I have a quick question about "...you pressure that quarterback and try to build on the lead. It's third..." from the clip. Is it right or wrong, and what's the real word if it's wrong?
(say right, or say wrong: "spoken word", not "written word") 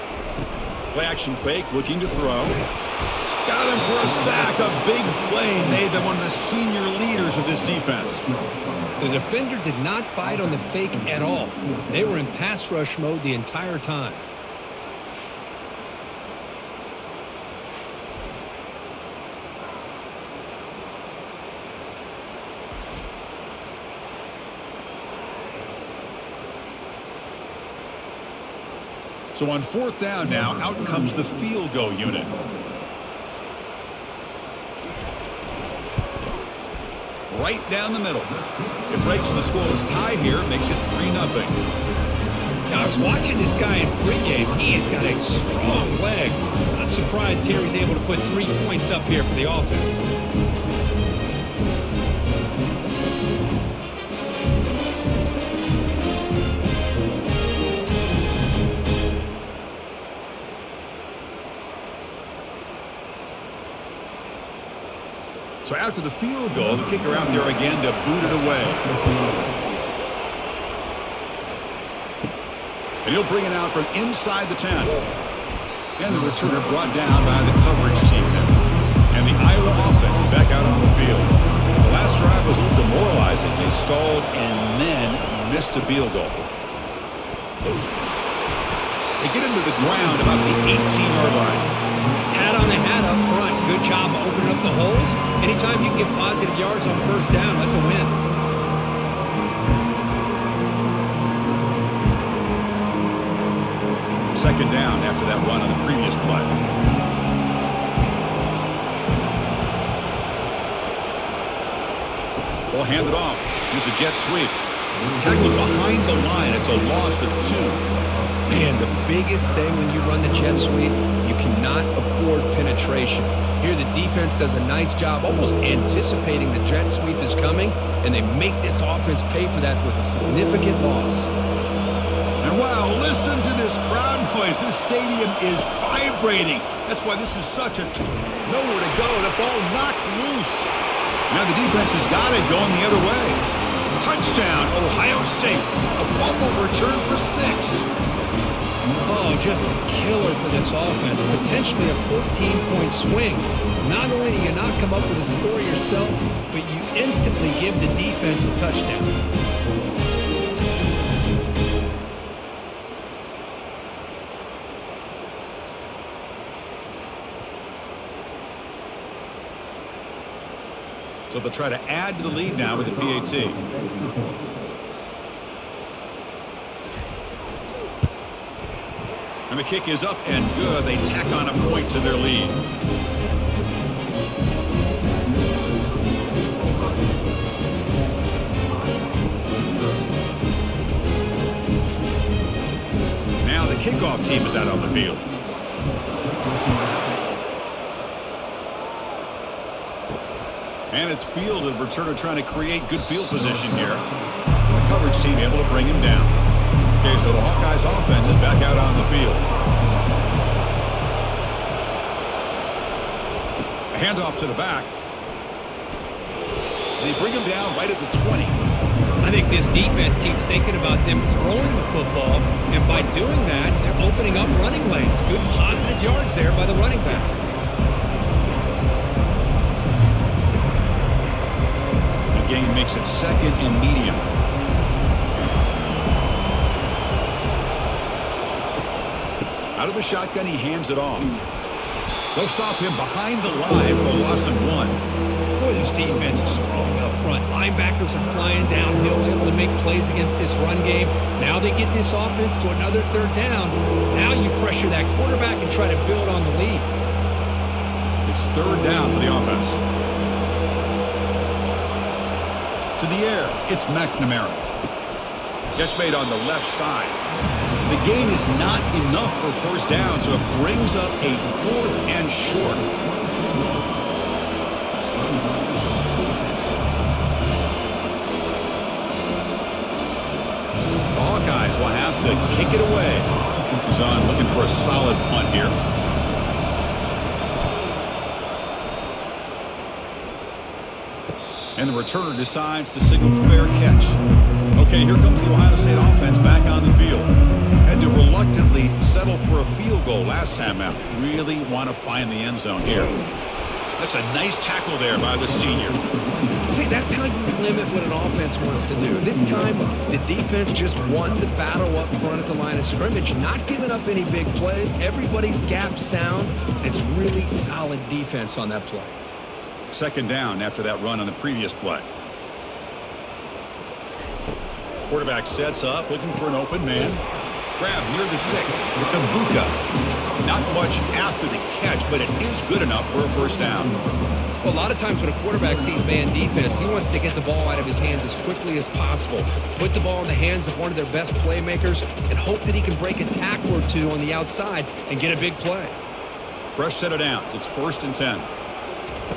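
right.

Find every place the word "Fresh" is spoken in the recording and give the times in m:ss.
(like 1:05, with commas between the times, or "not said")
5:46.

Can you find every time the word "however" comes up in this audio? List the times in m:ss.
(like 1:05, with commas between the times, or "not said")
not said.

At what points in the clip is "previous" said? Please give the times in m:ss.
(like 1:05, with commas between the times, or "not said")
1:45, 5:21.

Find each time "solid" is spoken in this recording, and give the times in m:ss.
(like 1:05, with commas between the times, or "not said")
4:44, 5:17.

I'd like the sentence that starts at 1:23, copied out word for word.
They stalled and then missed a field goal.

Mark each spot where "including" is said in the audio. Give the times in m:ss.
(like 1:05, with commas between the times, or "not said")
not said.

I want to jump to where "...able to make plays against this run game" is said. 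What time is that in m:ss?
4:09.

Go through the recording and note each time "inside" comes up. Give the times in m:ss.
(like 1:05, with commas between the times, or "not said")
1:13.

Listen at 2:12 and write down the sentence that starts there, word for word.
And wow, listen to this crowd noise.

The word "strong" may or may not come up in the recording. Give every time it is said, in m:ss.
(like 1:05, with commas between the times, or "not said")
0:45, 4:06.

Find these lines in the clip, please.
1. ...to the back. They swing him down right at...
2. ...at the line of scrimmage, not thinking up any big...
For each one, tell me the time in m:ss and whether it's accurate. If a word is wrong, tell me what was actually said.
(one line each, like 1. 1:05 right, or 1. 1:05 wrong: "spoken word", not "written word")
1. 3:34 wrong: "bring", not "swing"
2. 5:12 wrong: "giving", not "thinking".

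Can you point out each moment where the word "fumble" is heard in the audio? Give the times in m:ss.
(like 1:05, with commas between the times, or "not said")
2:26.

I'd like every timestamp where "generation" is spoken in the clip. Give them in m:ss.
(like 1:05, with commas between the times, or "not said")
not said.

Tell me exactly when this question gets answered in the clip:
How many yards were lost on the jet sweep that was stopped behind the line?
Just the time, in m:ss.
1:56.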